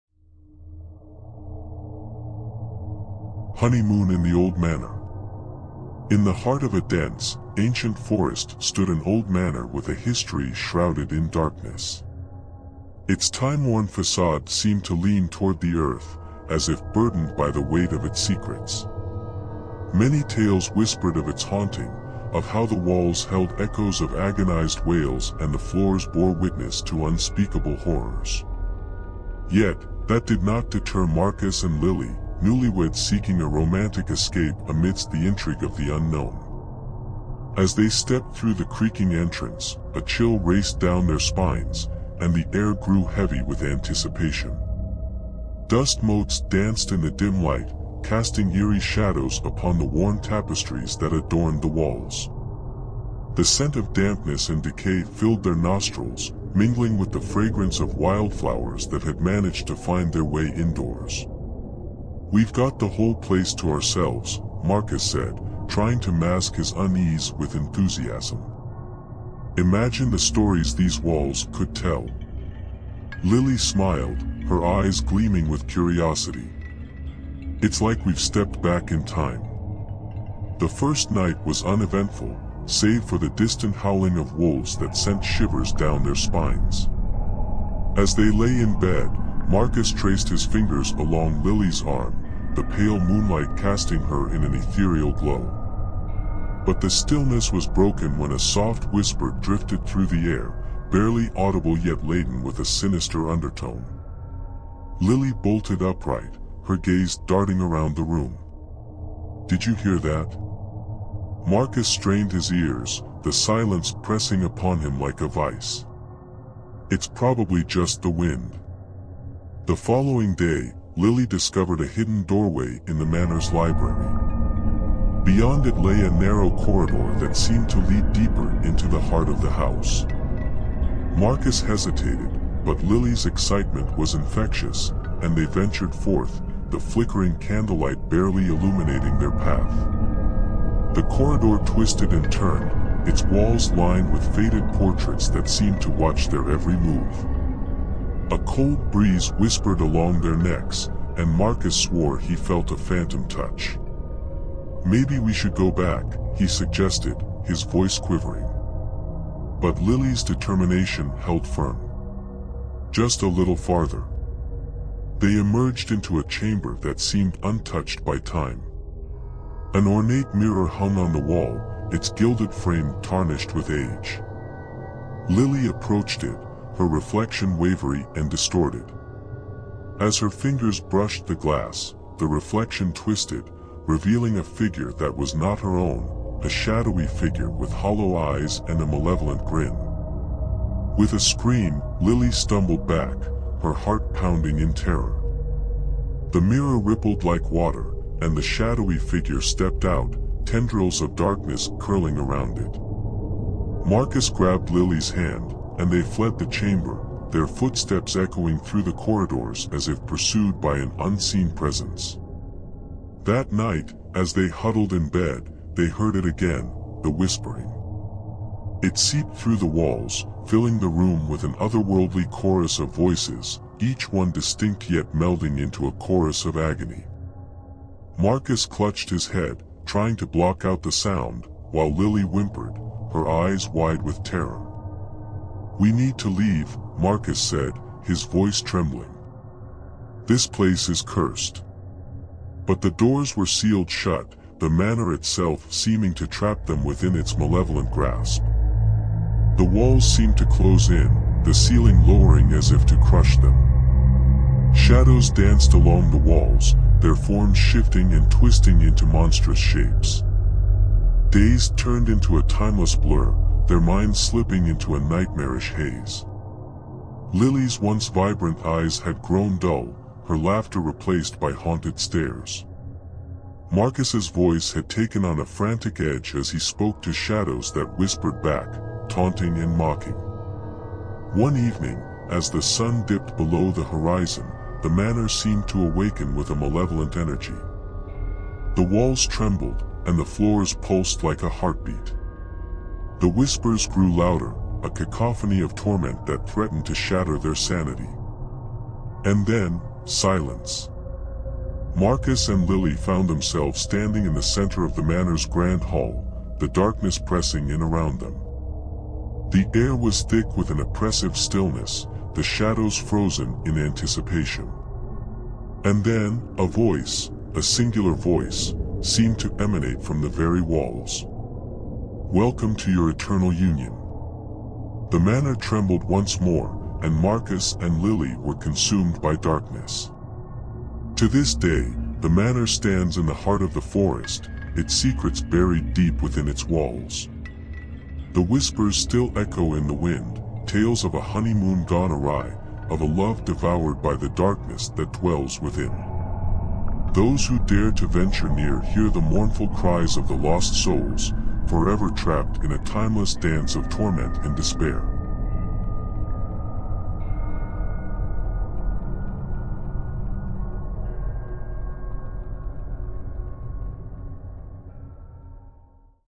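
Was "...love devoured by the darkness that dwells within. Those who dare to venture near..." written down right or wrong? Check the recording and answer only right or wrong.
right.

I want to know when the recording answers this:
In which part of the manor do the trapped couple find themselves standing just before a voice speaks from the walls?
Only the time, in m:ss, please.
5:05.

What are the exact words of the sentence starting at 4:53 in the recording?
The whispers grew louder, a cacophony of torment that threatened to shatter their sanity.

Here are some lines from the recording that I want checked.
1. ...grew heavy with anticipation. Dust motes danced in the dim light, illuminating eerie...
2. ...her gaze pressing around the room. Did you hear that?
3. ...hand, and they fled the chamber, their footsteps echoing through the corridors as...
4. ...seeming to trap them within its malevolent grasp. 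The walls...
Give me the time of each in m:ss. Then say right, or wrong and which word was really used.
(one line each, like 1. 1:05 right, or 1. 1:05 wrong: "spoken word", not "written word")
1. 0:42 wrong: "casting", not "illuminating"
2. 1:46 wrong: "darting", not "pressing"
3. 3:25 right
4. 4:05 right.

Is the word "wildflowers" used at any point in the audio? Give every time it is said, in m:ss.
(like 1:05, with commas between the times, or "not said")
0:57.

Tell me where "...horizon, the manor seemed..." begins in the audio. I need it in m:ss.
4:43.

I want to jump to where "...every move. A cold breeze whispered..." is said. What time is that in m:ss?
2:26.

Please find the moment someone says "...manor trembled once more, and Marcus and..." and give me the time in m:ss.
5:25.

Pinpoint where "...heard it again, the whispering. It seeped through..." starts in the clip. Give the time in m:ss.
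3:35.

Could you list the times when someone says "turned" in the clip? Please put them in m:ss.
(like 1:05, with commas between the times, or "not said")
2:22, 4:21.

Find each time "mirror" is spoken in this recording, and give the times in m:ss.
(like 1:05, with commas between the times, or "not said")
2:50, 3:16.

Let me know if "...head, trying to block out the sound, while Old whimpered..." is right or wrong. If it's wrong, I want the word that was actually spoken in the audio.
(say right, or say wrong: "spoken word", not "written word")
wrong: "Lily", not "Old".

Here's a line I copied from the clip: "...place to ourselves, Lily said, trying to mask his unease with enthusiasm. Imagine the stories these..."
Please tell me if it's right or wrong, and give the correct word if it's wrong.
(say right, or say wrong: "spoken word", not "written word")
wrong: "Marcus", not "Lily".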